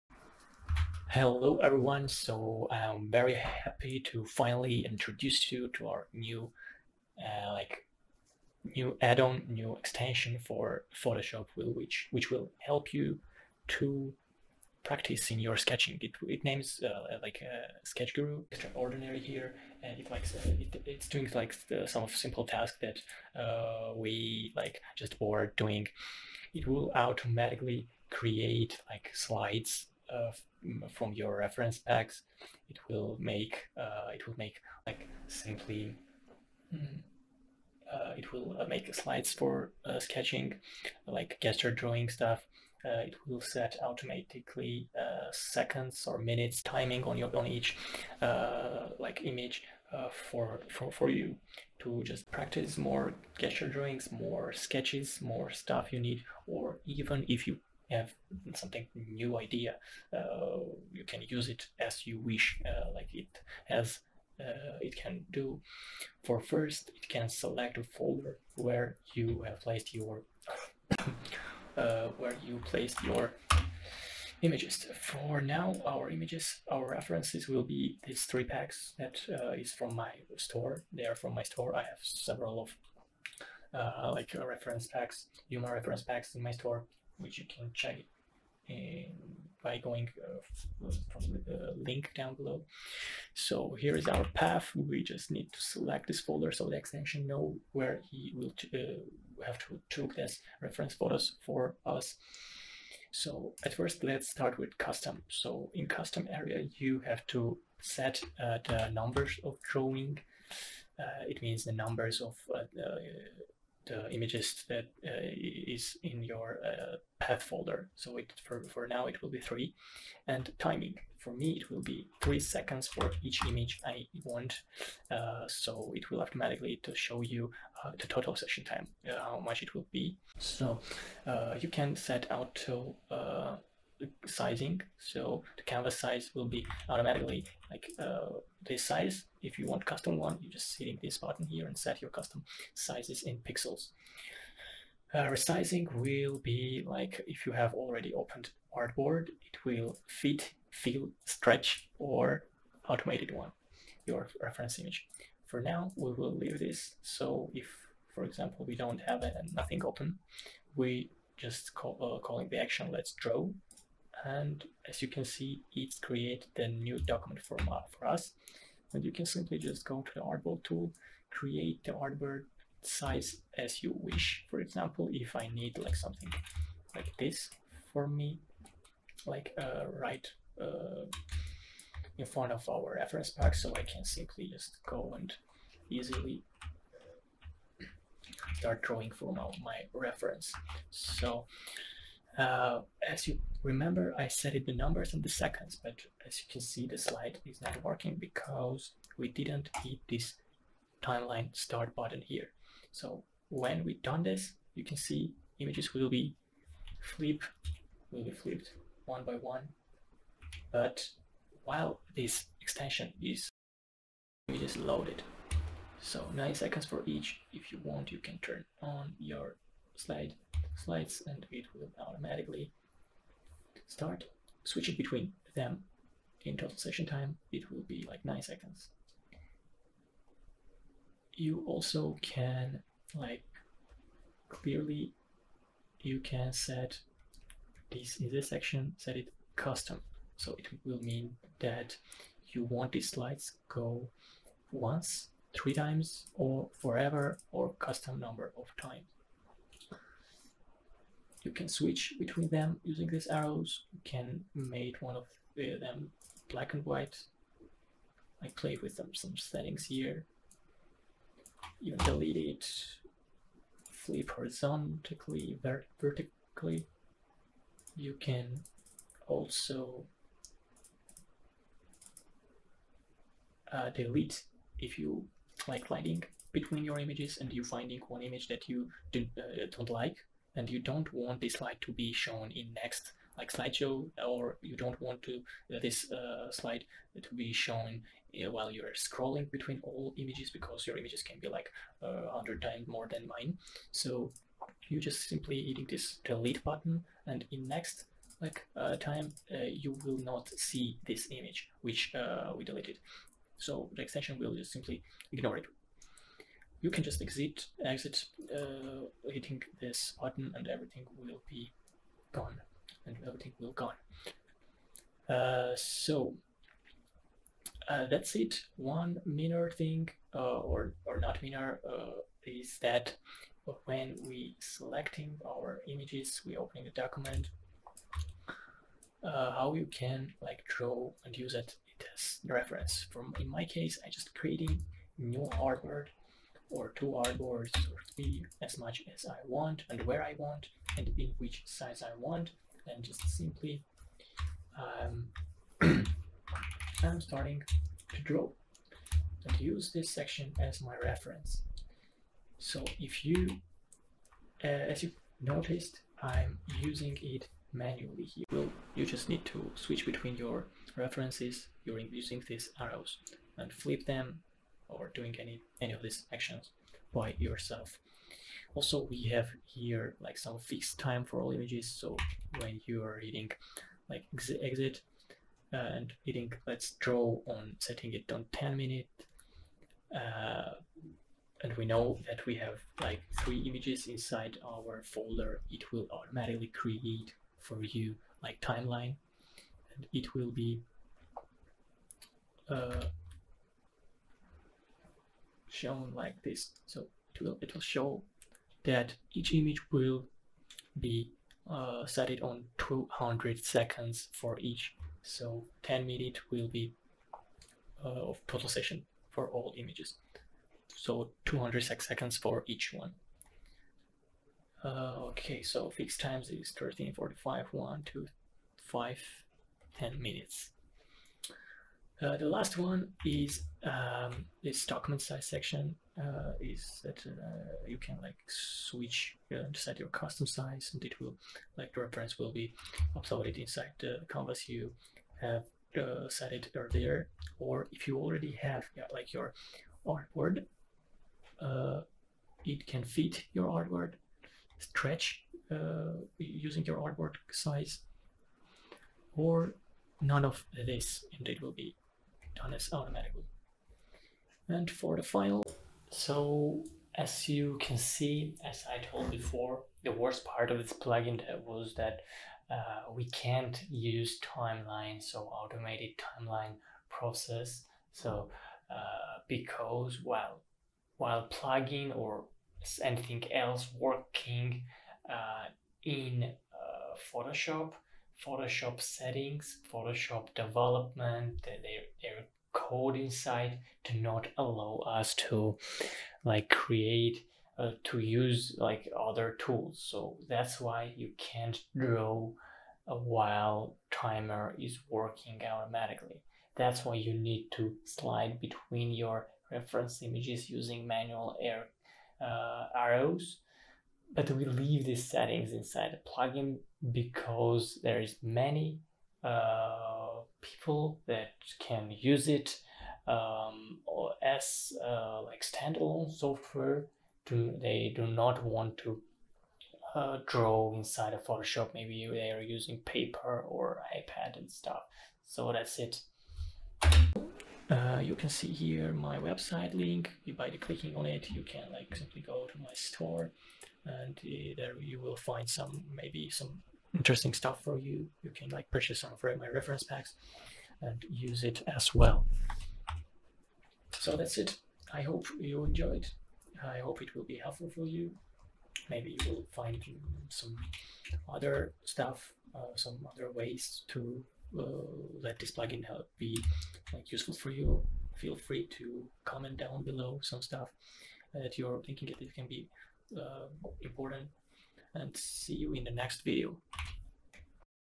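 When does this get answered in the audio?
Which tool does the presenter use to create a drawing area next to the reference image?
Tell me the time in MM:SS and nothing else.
02:50.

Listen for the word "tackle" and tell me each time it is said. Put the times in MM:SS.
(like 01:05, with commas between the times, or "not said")
not said.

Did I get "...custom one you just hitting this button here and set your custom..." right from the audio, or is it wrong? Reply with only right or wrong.
right.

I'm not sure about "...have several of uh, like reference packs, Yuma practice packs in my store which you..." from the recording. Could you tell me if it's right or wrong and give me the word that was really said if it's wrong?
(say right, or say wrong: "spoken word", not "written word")
wrong: "reference", not "practice".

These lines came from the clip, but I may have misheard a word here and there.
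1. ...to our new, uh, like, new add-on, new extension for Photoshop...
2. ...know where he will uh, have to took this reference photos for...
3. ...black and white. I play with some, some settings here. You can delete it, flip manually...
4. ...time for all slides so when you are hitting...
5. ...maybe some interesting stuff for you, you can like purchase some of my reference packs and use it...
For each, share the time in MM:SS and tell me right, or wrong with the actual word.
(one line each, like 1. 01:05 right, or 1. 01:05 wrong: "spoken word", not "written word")
1. 00:05 right
2. 01:37 right
3. 04:16 wrong: "horizontally", not "manually"
4. 06:10 wrong: "images", not "slides"
5. 08:56 right.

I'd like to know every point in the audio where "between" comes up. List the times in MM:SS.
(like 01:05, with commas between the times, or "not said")
03:44, 04:12, 04:36, 04:49, 06:00, 08:18.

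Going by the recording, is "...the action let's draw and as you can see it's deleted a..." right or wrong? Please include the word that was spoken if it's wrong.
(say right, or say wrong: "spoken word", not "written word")
wrong: "created", not "deleted".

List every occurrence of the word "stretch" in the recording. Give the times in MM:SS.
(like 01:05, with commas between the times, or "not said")
02:31, 07:24.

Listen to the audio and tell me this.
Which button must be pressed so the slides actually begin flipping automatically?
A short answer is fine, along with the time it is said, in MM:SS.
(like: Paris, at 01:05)
timeline start, at 03:21.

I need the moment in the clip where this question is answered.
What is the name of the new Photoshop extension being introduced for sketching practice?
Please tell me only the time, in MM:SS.
00:17.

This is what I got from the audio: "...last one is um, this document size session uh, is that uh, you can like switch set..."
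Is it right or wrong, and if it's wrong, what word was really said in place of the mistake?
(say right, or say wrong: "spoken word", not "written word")
wrong: "section", not "session".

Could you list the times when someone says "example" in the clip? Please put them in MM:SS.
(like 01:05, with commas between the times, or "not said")
02:38, 02:54.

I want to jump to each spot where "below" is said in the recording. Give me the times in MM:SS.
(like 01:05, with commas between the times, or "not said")
01:32, 09:20.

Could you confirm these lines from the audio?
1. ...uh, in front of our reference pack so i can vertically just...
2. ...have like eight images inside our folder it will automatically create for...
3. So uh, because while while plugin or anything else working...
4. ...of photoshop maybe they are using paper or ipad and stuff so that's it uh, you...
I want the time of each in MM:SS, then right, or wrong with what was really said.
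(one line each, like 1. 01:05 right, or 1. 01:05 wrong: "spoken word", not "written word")
1. 03:00 wrong: "simply", not "vertically"
2. 06:22 wrong: "three", not "eight"
3. 07:48 right
4. 08:41 right.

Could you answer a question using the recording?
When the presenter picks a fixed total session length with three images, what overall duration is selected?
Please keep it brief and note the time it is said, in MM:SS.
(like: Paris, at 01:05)
10 minutes, at 06:18.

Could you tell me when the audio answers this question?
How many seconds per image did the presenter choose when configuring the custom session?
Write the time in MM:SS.
02:02.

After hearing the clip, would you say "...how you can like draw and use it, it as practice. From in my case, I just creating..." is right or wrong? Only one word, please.
wrong.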